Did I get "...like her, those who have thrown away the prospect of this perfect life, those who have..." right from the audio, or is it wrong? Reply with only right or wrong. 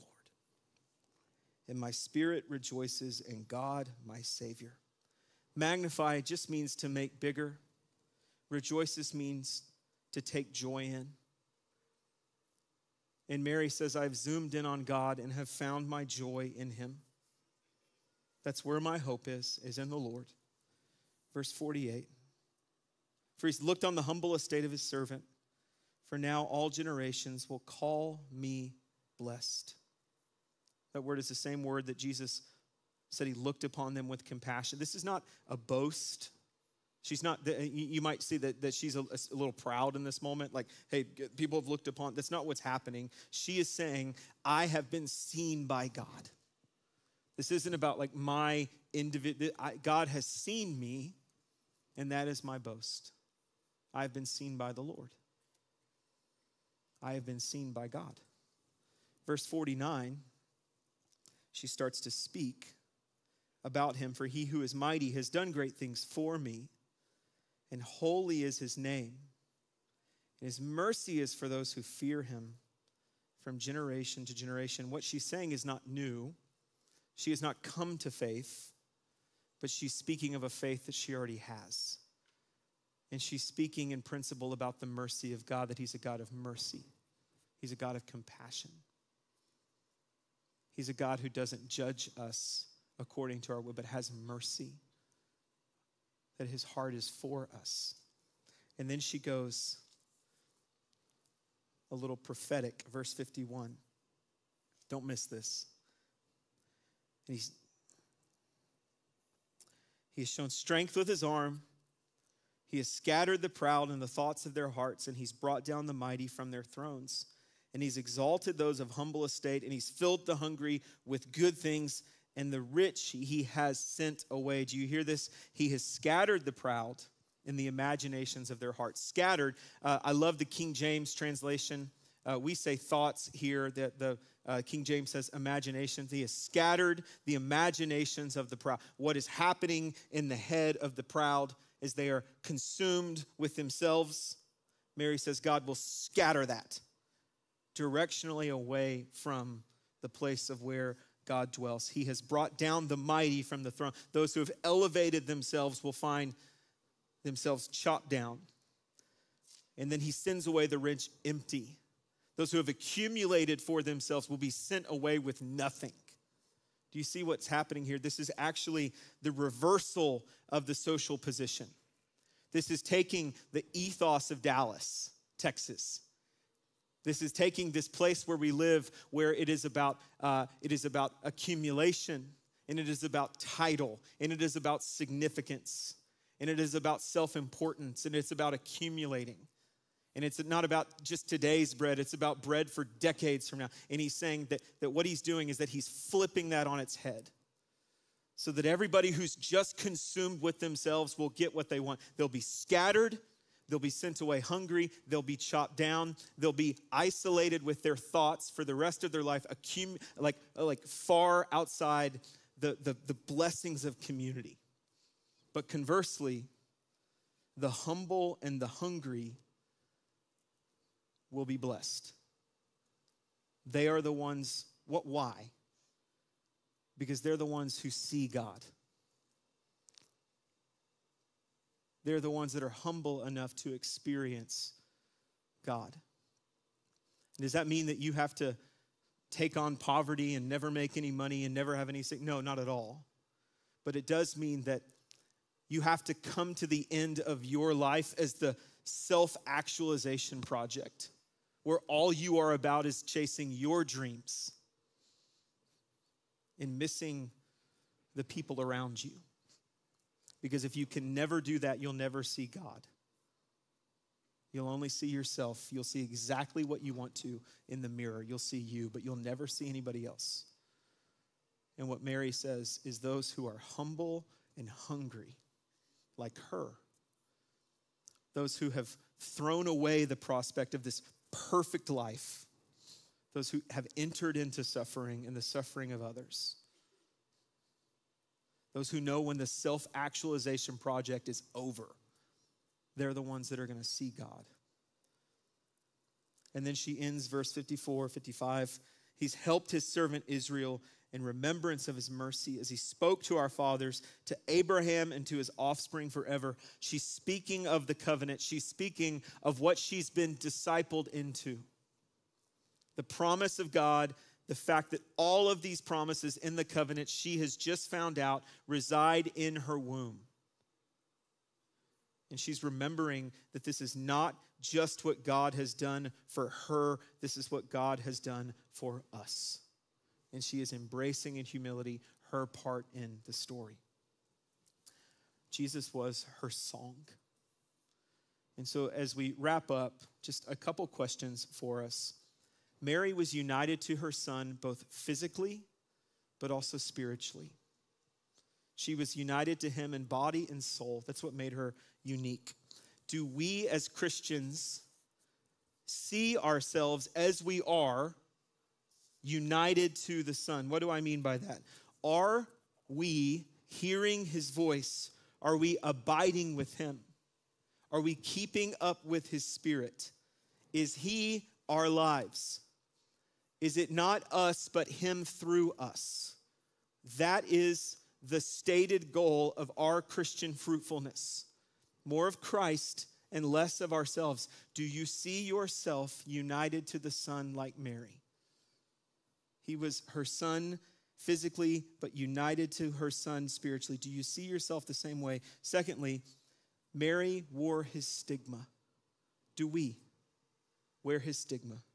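right.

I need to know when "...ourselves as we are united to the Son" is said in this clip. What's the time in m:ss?
5:56.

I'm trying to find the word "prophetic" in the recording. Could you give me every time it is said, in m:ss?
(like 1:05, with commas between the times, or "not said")
1:42.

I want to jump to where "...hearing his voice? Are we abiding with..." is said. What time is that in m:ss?
6:03.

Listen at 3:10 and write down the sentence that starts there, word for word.
And it's not about just today's bread, it's about bread for decades from now.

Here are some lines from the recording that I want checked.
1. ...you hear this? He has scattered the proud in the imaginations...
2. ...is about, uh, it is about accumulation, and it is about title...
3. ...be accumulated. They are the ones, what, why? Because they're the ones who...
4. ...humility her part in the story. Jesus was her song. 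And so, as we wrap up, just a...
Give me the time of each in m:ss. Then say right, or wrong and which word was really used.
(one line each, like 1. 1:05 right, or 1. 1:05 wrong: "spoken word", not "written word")
1. 2:04 right
2. 2:59 right
3. 3:41 wrong: "blessed", not "accumulated"
4. 5:31 right.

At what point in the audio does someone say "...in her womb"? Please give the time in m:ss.
5:19.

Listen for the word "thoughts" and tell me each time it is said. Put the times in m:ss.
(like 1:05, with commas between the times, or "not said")
1:54, 2:12, 3:27.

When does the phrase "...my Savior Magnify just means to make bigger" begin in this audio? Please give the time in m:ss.
0:04.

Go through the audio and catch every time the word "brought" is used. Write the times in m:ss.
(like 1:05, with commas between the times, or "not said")
1:55, 2:32.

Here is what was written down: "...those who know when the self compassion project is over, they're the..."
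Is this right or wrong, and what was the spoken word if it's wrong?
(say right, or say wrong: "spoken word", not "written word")
wrong: "actualization", not "compassion".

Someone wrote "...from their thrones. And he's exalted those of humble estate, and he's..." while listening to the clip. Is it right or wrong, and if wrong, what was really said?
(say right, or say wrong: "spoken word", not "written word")
right.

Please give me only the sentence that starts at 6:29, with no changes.
He was her Son physically, but united to her Son spiritually.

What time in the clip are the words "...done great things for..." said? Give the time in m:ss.
1:05.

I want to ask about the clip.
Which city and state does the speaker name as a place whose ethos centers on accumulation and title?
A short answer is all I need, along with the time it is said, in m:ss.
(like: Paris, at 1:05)
Dallas, Texas, at 2:54.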